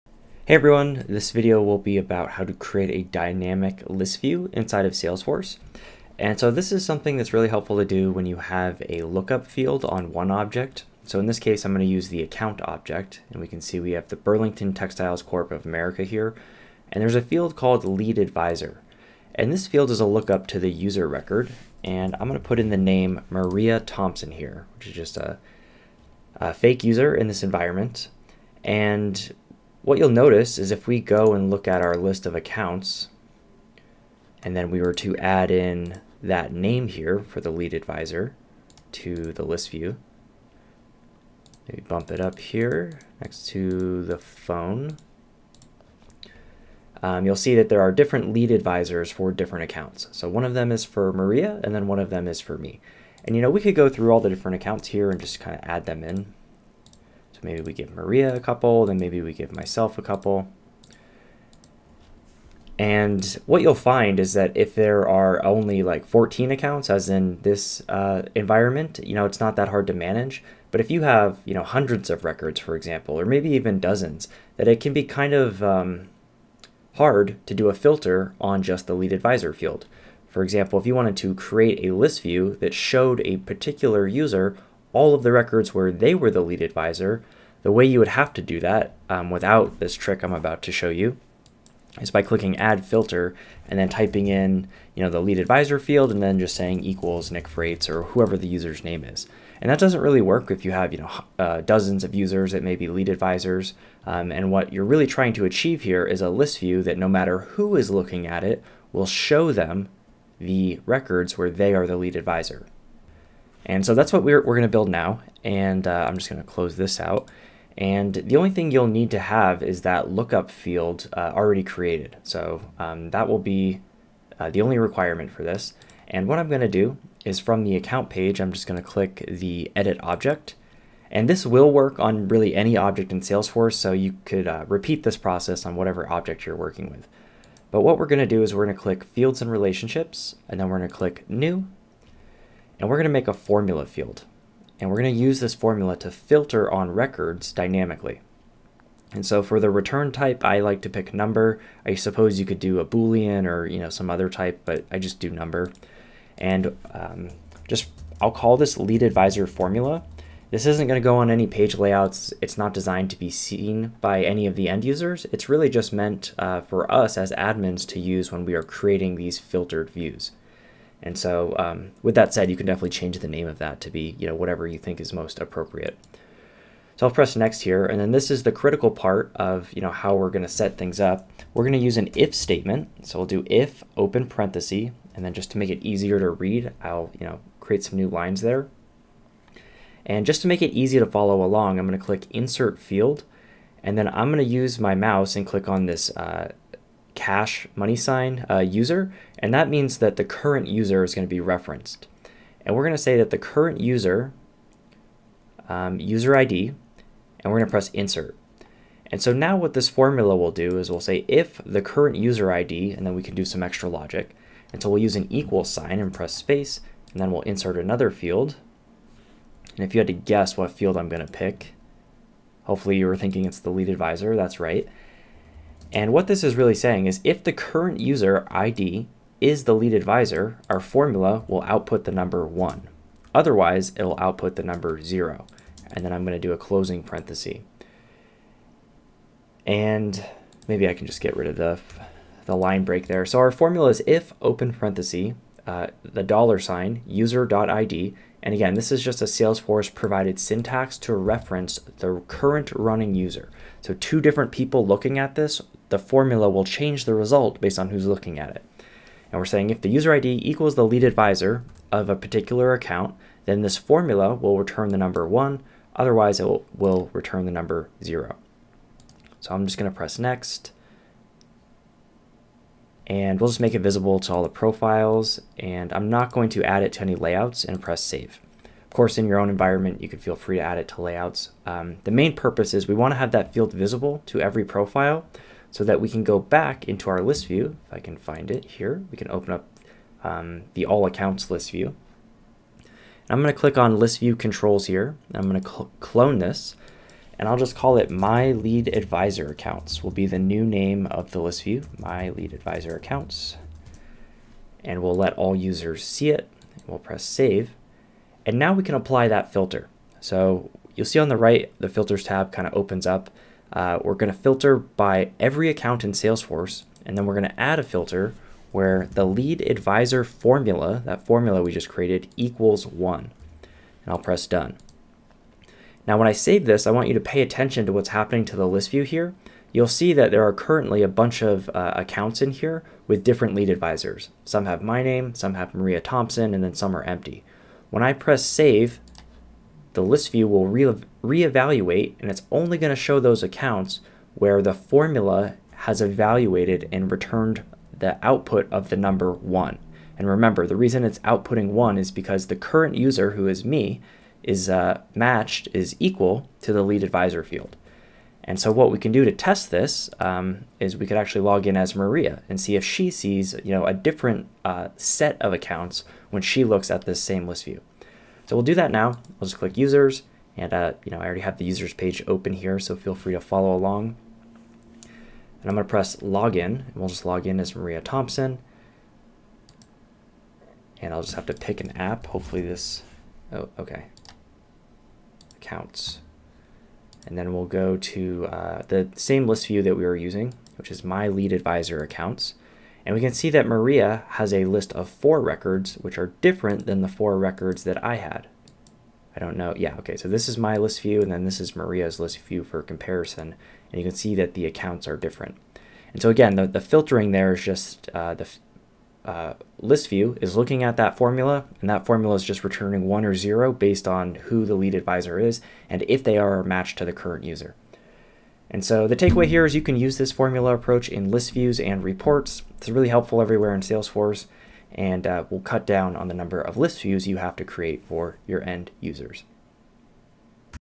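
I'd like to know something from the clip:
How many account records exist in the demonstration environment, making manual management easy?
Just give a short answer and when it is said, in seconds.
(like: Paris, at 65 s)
14, at 66 s.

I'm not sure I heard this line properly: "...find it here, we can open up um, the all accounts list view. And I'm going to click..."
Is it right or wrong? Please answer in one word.
right.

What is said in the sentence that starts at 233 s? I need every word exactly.
Otherwise, it'll output the number 0.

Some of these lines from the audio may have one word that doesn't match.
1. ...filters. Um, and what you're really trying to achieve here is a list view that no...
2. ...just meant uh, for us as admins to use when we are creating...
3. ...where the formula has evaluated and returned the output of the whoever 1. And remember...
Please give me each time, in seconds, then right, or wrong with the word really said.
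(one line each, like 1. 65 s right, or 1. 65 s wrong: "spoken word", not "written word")
1. 103 s wrong: "advisors", not "filters"
2. 165 s right
3. 344 s wrong: "number", not "whoever".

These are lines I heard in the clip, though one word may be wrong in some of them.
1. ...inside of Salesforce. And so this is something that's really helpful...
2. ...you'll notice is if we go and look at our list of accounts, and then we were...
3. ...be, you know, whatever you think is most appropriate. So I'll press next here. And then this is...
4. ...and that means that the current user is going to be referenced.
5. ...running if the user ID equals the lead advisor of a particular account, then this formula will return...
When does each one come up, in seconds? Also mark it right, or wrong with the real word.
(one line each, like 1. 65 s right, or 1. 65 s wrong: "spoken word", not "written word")
1. 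4 s right
2. 29 s right
3. 173 s right
4. 199 s right
5. 259 s wrong: "saying", not "running".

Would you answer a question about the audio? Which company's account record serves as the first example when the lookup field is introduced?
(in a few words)
Burlington Textiles Corp of America.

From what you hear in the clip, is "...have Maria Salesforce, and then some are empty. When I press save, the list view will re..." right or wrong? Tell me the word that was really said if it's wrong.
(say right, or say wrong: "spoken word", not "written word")
wrong: "Thompson", not "Salesforce".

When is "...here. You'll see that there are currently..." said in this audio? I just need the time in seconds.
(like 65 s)
329 s.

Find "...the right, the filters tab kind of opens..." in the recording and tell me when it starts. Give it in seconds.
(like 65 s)
311 s.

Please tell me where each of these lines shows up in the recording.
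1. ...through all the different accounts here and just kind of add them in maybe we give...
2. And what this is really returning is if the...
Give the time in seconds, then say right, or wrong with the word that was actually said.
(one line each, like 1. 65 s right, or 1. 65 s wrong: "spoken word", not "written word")
1. 53 s right
2. 225 s wrong: "saying", not "returning".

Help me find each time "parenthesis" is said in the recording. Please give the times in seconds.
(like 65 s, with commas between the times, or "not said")
184 s, 237 s, 244 s.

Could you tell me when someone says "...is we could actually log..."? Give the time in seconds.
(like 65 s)
360 s.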